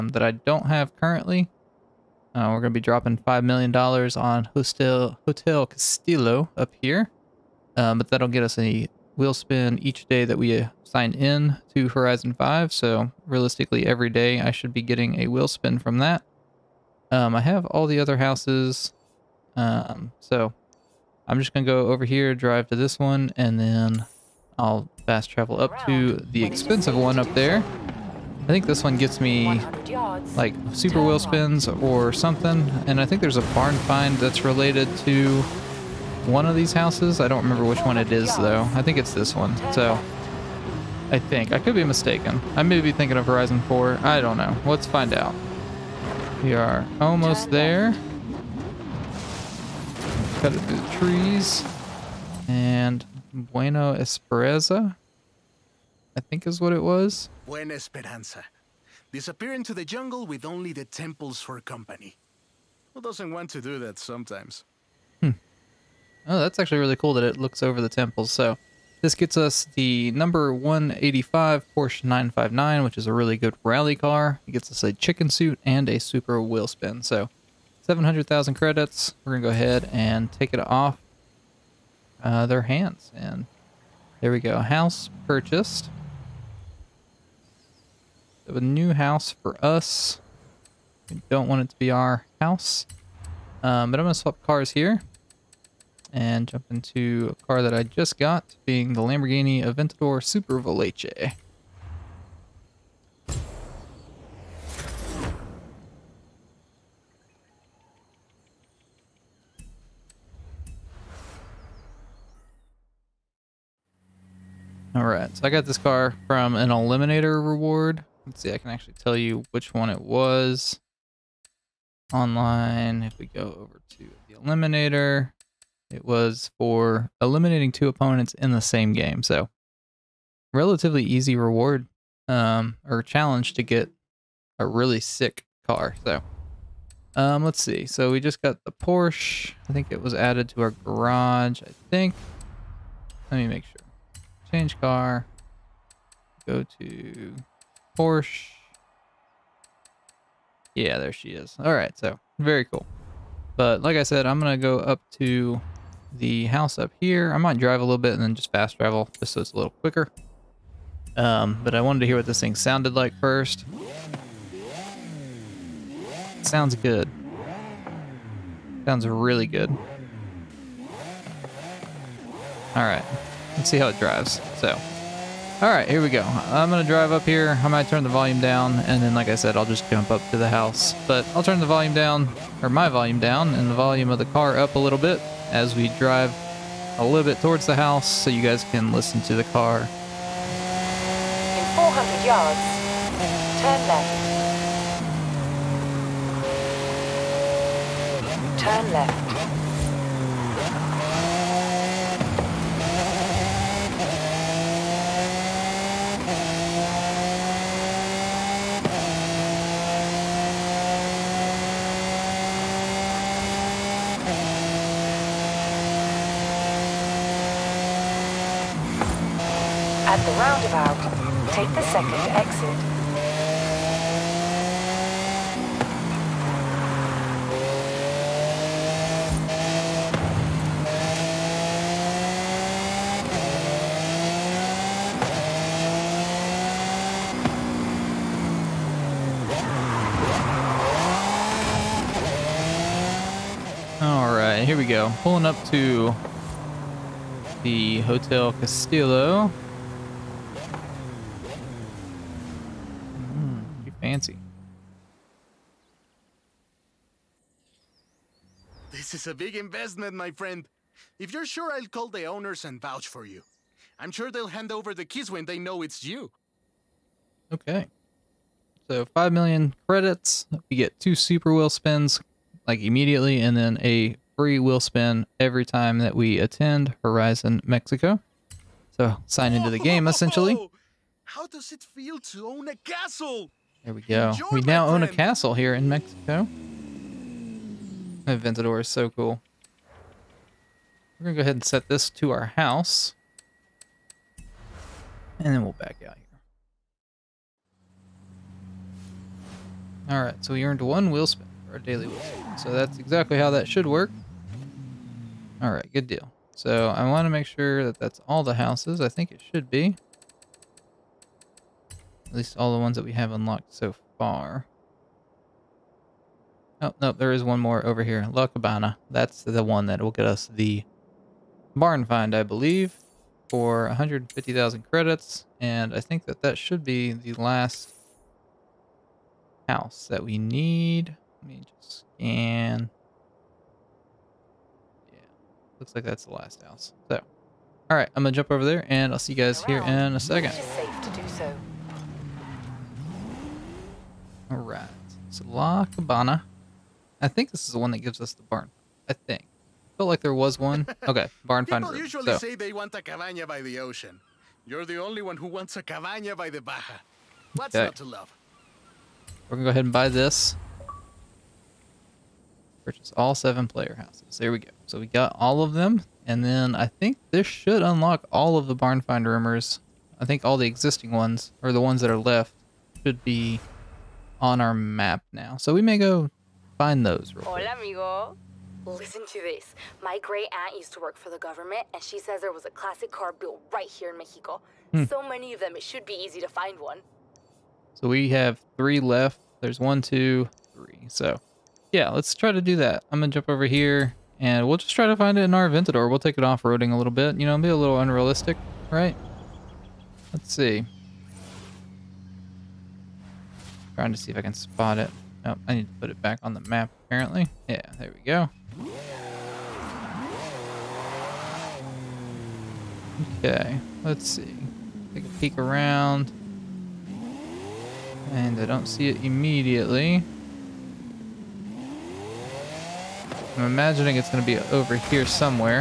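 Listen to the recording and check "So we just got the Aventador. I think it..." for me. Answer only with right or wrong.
wrong.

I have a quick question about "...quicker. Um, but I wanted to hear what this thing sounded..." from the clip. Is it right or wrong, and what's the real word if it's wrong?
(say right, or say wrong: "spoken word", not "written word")
right.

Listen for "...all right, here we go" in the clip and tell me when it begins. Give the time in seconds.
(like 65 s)
175 s.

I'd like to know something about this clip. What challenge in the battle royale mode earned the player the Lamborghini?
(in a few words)
eliminating two opponents.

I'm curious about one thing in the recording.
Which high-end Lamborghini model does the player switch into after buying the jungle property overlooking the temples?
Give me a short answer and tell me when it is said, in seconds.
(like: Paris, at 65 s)
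Aventador Super Veloce, at 99 s.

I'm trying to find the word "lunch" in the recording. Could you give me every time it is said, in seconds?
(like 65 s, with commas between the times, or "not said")
not said.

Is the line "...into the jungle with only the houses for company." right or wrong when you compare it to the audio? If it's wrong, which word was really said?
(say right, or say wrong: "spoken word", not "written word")
wrong: "temples", not "houses".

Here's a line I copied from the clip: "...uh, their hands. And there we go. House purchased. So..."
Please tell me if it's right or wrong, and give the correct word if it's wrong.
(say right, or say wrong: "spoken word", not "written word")
right.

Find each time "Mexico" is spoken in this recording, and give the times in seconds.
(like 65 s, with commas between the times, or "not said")
277 s, 285 s, 384 s.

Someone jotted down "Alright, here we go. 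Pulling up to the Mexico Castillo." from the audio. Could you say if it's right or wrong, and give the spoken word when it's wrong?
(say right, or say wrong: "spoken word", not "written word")
wrong: "Hotel", not "Mexico".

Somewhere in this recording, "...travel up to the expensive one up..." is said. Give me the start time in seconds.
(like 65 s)
25 s.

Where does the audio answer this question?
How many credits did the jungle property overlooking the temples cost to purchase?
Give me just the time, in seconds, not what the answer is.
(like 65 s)
77 s.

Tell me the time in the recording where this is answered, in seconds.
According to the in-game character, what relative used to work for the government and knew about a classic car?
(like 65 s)
380 s.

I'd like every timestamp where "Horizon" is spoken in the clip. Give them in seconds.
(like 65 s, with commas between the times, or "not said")
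11 s, 43 s, 277 s.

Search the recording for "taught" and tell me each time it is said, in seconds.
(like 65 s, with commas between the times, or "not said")
not said.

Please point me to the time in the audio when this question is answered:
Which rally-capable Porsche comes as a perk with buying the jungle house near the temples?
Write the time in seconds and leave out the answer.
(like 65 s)
71 s.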